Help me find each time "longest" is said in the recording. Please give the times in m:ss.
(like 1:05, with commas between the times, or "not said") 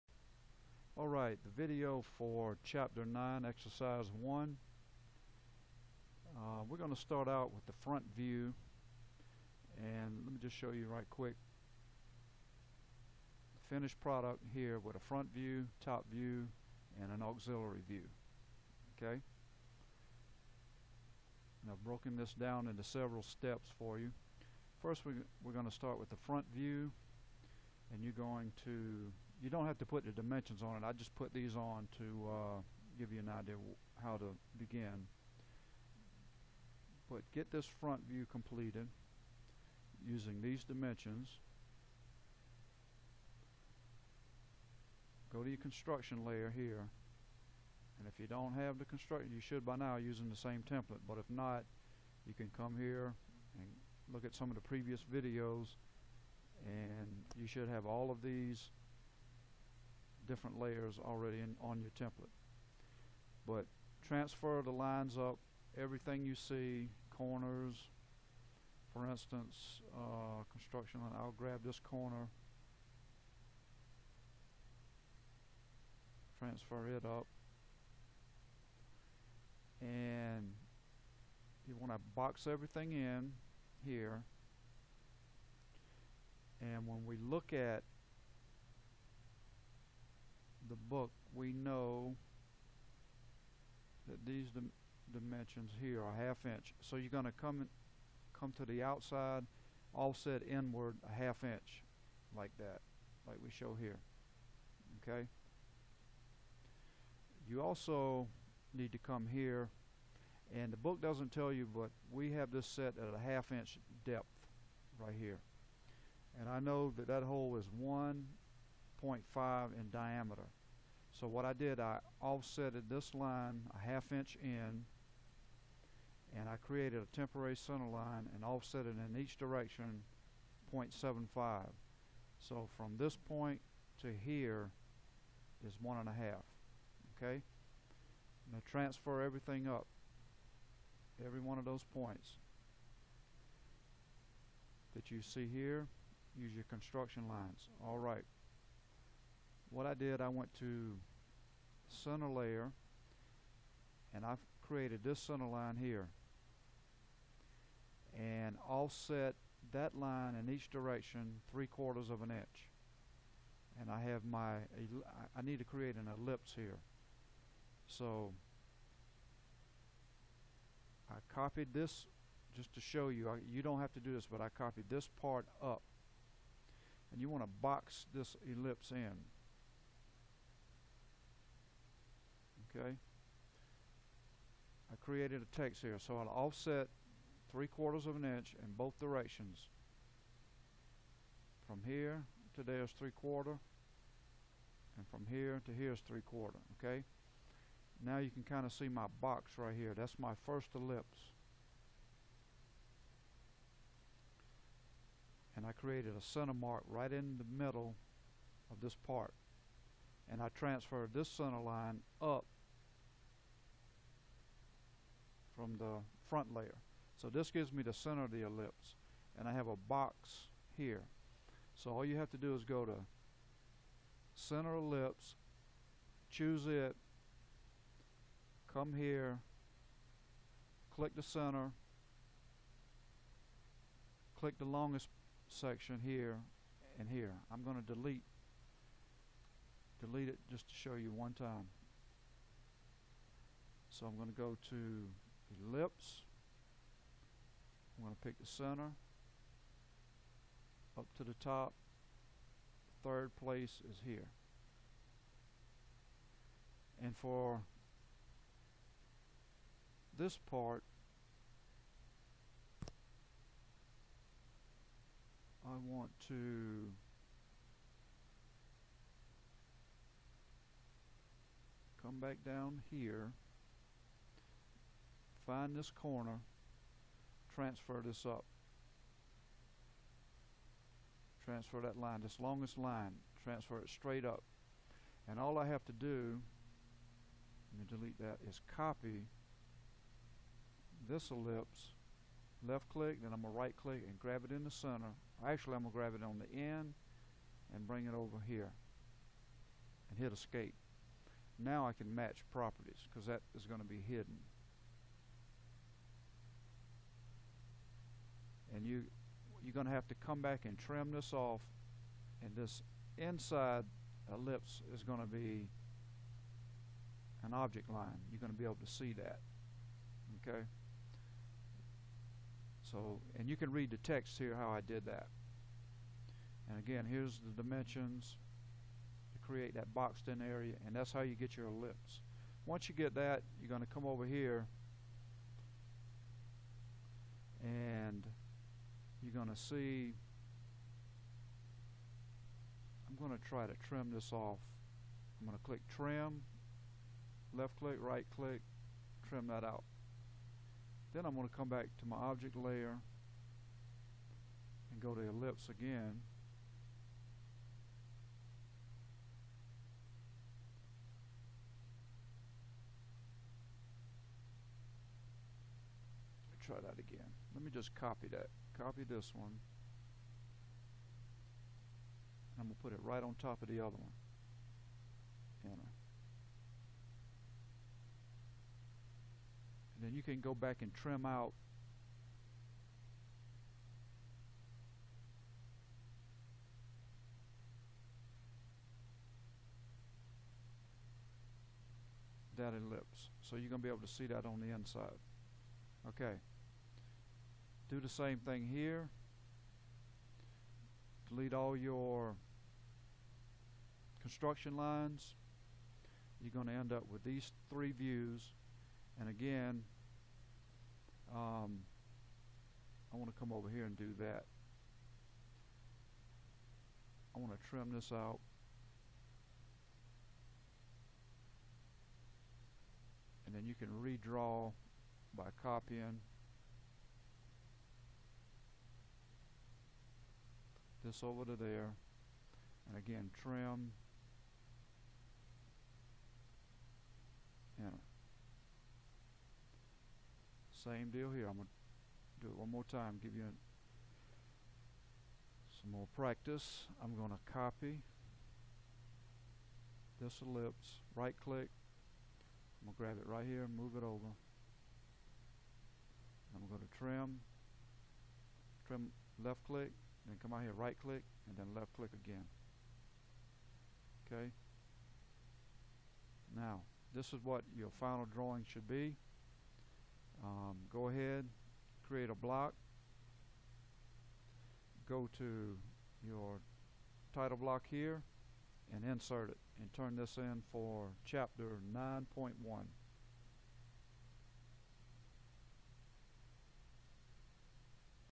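3:54, 4:42.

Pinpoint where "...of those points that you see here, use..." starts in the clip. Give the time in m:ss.
2:21.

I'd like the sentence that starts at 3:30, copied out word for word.
And I transferred this center line up from the front layer.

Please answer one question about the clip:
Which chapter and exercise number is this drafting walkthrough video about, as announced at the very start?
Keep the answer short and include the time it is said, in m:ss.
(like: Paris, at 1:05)
Chapter 9, Exercise 1, at 0:02.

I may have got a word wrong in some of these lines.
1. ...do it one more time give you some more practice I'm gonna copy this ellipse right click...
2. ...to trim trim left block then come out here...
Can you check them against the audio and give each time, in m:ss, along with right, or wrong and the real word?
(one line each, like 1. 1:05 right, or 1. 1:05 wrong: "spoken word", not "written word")
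1. 7:22 right
2. 7:36 wrong: "click", not "block".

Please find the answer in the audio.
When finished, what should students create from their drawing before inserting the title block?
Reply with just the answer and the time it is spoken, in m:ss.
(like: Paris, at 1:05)
a block, at 7:52.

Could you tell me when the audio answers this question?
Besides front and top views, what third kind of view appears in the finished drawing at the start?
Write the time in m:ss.
0:17.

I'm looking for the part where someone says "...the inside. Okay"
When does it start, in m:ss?
6:34.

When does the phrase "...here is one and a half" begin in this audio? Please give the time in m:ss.
2:14.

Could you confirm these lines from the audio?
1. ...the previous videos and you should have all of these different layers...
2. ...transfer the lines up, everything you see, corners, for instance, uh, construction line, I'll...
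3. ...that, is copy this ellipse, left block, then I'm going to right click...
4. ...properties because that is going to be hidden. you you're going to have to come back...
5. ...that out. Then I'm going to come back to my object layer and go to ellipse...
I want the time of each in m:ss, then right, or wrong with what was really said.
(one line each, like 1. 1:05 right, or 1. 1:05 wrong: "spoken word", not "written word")
1. 0:54 right
2. 1:04 right
3. 4:48 wrong: "click", not "block"
4. 5:02 right
5. 5:49 right.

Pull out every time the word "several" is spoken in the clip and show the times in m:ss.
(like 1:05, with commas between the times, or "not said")
0:22.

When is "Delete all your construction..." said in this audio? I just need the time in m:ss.
6:41.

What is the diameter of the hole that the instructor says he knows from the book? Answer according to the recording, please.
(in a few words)
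1.5.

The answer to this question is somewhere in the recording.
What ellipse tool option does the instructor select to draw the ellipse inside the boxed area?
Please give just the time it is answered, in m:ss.
3:44.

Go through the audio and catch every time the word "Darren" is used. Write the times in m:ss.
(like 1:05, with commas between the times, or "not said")
not said.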